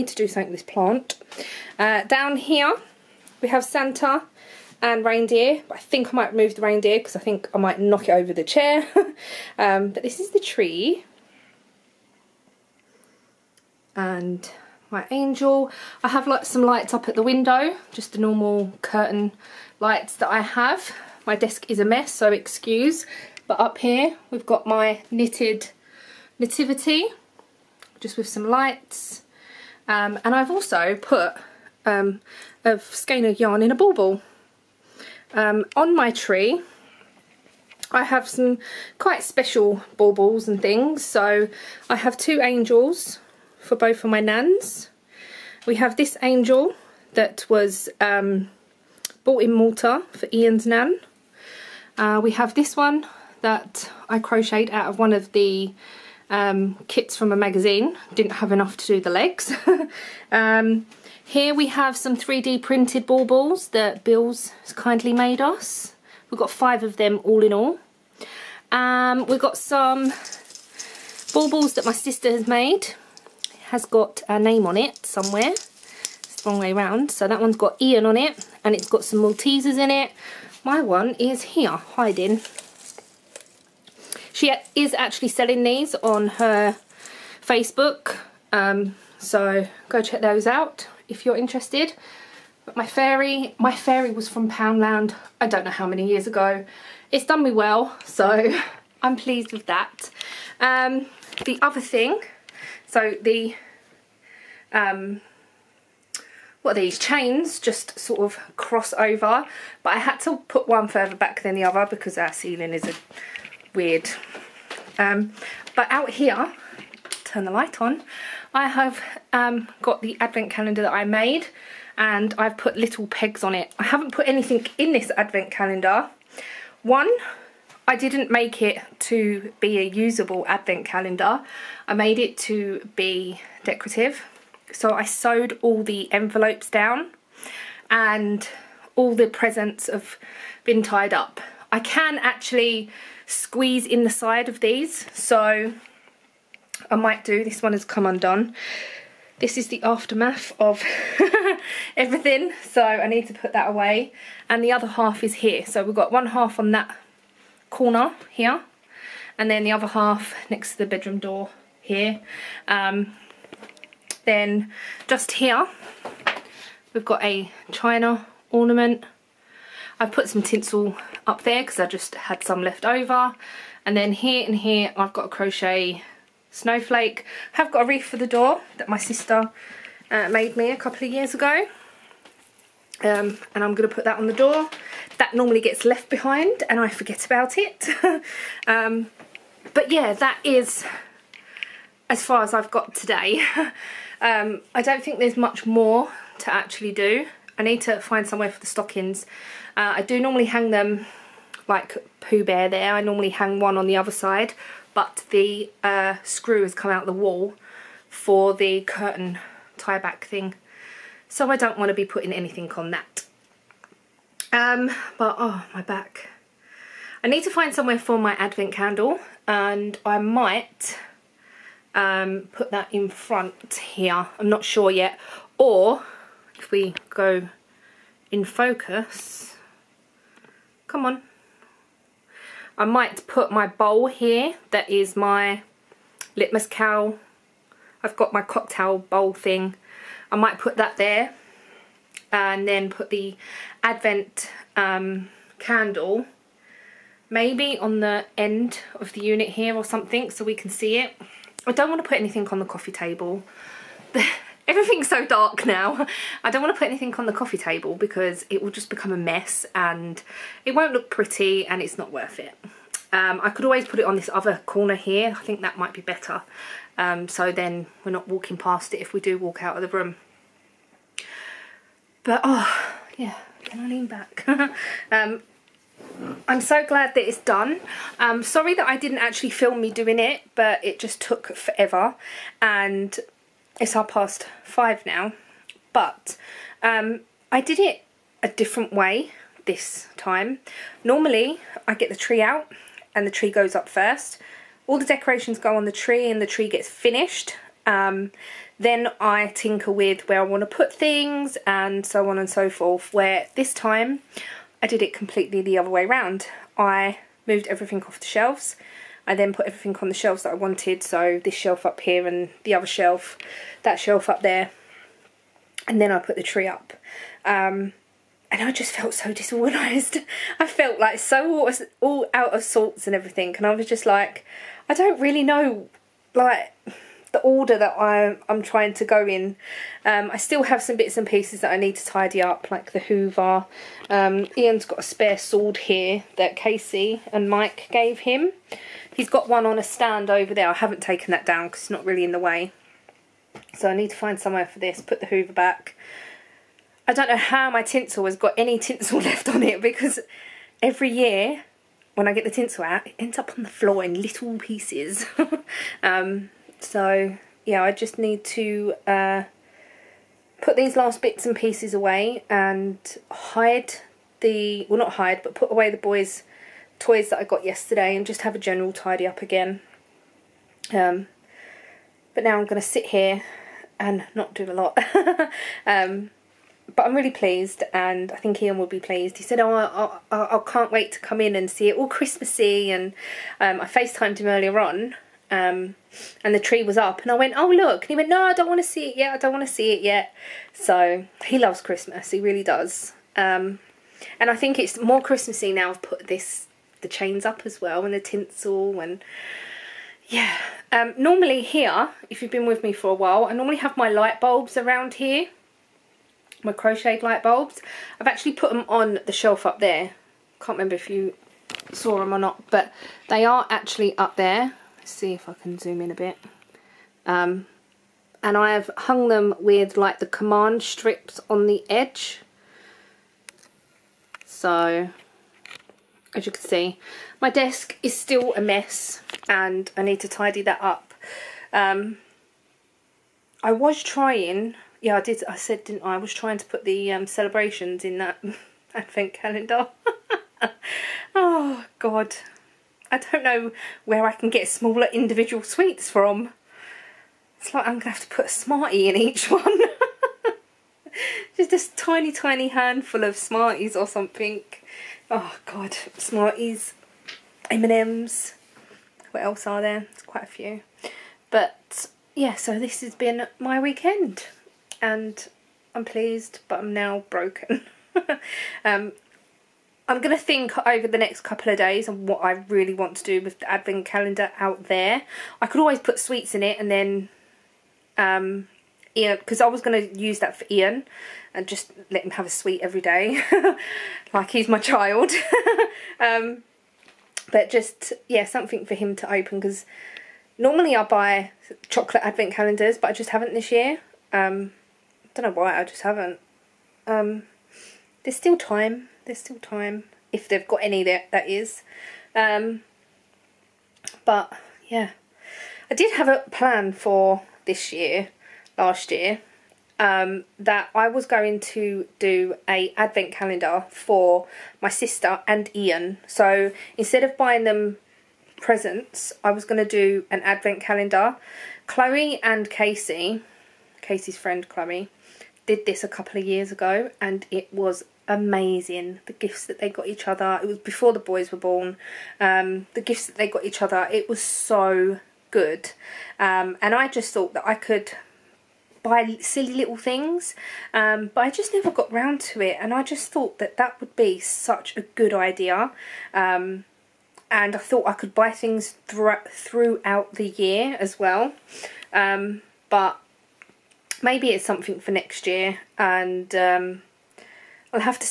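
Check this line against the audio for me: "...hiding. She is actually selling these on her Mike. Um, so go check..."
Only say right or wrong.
wrong.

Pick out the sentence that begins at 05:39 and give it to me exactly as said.
He's got one on a stand over there.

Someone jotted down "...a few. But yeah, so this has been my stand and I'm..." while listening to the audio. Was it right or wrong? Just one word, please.
wrong.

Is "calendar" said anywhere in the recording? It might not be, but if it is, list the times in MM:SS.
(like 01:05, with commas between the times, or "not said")
02:00, 02:05, 02:10, 07:19, 07:54, 08:12, 08:33, 08:40.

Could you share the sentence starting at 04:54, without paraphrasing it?
All the decorations go on the tree and the tree gets finished.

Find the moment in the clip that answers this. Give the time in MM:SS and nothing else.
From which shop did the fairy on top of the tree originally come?
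01:34.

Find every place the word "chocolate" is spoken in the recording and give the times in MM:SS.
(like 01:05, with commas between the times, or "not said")
08:11.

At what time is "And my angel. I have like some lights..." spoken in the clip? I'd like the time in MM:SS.
00:13.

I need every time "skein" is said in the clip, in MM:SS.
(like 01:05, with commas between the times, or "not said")
00:32.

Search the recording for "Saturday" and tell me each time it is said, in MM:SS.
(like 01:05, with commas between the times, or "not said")
not said.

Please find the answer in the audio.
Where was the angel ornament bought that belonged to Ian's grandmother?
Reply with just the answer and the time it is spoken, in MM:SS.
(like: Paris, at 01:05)
Malta, at 00:49.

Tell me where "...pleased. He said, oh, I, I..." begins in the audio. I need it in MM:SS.
06:18.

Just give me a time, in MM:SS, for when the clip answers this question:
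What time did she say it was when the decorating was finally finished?
04:43.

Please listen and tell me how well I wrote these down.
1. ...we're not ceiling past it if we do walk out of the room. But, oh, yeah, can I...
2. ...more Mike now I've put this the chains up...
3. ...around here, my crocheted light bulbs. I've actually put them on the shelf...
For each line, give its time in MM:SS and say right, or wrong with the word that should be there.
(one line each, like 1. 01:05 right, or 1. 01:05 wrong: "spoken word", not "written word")
1. 04:28 wrong: "walking", not "ceiling"
2. 06:34 wrong: "Christmassy", not "Mike"
3. 06:44 right.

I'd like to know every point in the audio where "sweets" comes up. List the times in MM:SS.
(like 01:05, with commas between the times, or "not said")
07:25, 07:56, 08:02.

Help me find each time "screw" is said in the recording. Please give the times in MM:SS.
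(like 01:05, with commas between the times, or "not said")
03:26.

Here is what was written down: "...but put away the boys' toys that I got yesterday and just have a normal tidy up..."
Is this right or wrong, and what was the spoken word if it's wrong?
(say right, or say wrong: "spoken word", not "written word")
wrong: "general", not "normal".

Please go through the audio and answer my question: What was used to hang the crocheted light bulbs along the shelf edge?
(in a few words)
Command strips.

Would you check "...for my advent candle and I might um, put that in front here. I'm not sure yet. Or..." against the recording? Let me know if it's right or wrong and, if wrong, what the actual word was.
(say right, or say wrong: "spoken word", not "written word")
right.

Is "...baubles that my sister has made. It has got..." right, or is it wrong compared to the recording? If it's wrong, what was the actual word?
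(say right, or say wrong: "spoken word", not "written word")
right.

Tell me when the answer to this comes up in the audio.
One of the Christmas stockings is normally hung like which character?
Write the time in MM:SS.
03:22.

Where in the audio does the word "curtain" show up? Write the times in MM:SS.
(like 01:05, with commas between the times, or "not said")
00:18, 03:28.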